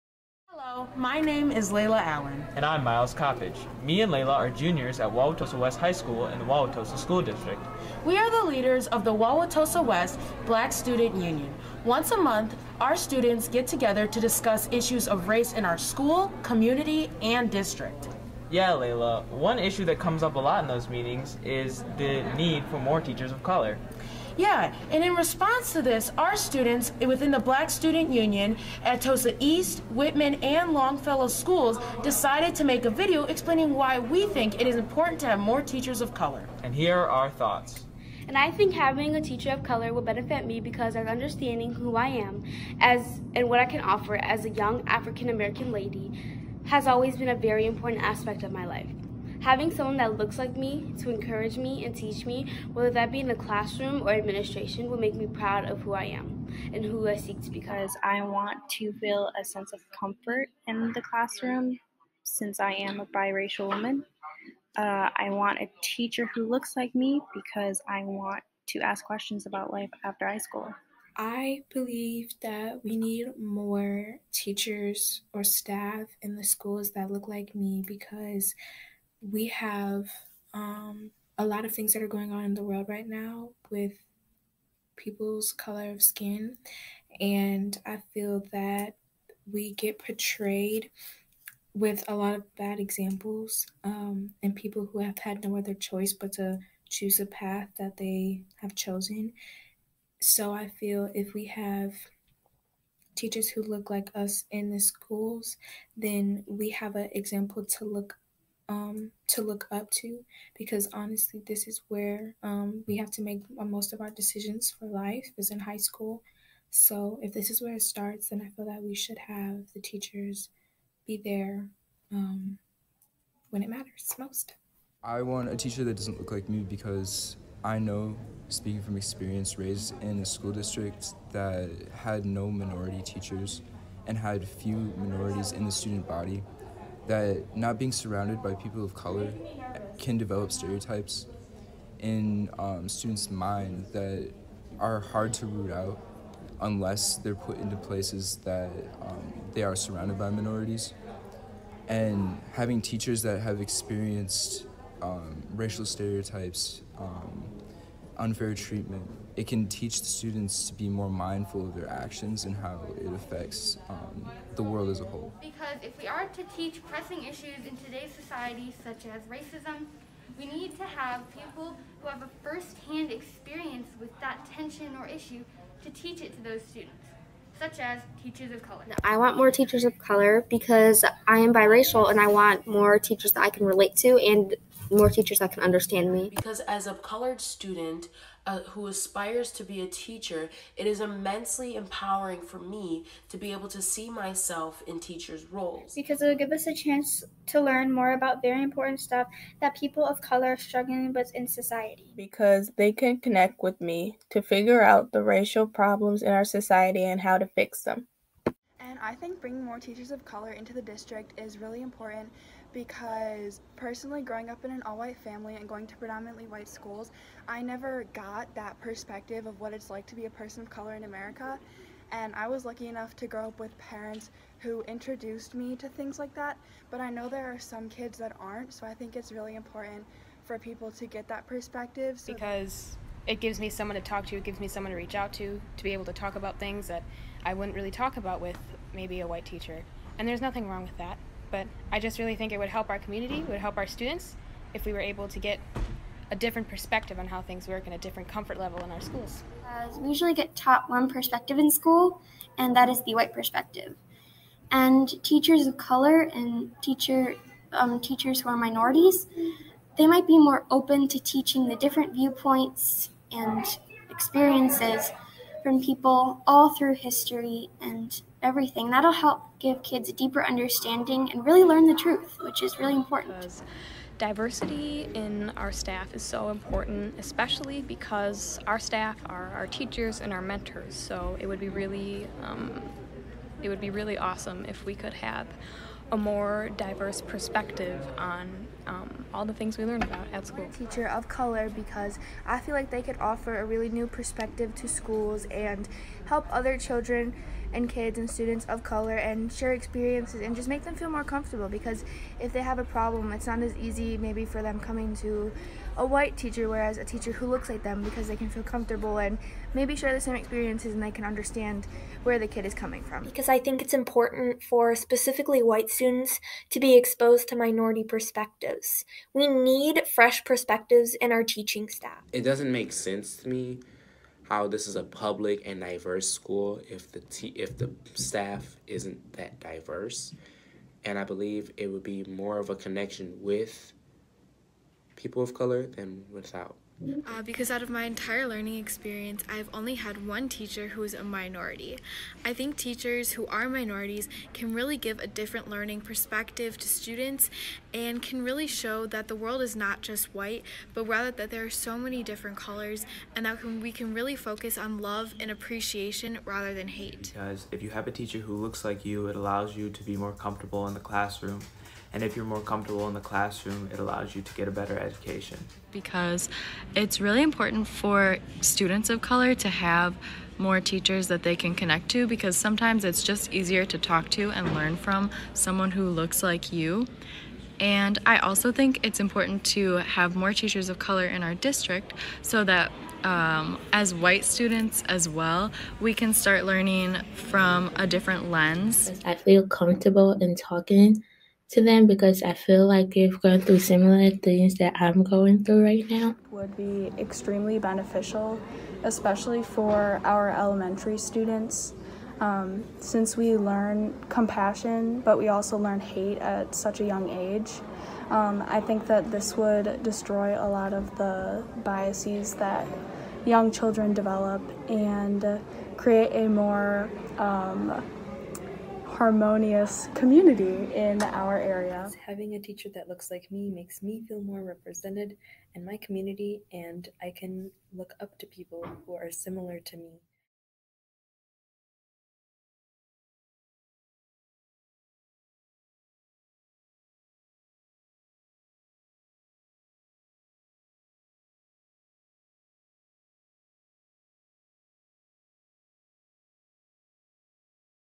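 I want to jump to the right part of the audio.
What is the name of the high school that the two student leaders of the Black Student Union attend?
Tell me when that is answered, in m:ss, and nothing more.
0:05.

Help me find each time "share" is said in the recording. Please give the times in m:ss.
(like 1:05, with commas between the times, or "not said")
4:59, 5:09.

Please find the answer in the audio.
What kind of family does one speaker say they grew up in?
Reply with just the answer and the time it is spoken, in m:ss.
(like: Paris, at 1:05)
all-white family, at 3:34.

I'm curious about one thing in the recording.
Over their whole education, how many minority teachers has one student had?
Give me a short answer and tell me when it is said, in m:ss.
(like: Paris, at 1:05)
1, at 5:40.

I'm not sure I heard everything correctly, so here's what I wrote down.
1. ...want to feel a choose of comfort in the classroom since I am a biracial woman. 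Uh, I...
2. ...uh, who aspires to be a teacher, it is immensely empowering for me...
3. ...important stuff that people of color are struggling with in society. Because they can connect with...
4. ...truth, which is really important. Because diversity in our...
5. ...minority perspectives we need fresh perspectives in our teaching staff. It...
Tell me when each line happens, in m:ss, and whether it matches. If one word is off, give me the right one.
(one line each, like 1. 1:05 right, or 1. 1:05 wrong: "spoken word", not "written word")
1. 0:58 wrong: "sense", not "choose"
2. 3:08 right
3. 3:18 right
4. 4:31 right
5. 5:17 right.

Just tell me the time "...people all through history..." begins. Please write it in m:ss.
4:25.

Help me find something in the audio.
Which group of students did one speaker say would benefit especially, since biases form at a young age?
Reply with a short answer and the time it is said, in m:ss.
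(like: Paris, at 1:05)
elementary students, at 6:40.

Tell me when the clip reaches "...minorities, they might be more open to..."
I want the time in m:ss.
4:18.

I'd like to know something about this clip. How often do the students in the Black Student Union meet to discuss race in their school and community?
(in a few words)
Once a month.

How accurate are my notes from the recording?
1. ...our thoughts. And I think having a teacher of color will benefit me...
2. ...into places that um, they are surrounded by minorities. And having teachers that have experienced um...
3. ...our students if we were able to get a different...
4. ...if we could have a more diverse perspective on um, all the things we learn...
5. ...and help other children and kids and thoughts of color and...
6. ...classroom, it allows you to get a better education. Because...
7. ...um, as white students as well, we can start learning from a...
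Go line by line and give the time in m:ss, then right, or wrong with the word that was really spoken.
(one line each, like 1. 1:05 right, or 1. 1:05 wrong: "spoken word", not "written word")
1. 0:37 right
2. 2:27 right
3. 4:03 right
4. 4:44 right
5. 4:55 wrong: "students", not "thoughts"
6. 6:03 right
7. 6:23 right.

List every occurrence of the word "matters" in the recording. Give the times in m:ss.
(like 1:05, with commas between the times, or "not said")
2:03.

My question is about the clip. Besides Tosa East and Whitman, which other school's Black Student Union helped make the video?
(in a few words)
Longfellow.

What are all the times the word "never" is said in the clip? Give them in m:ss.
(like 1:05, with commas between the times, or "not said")
3:37.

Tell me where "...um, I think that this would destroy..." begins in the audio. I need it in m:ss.
6:48.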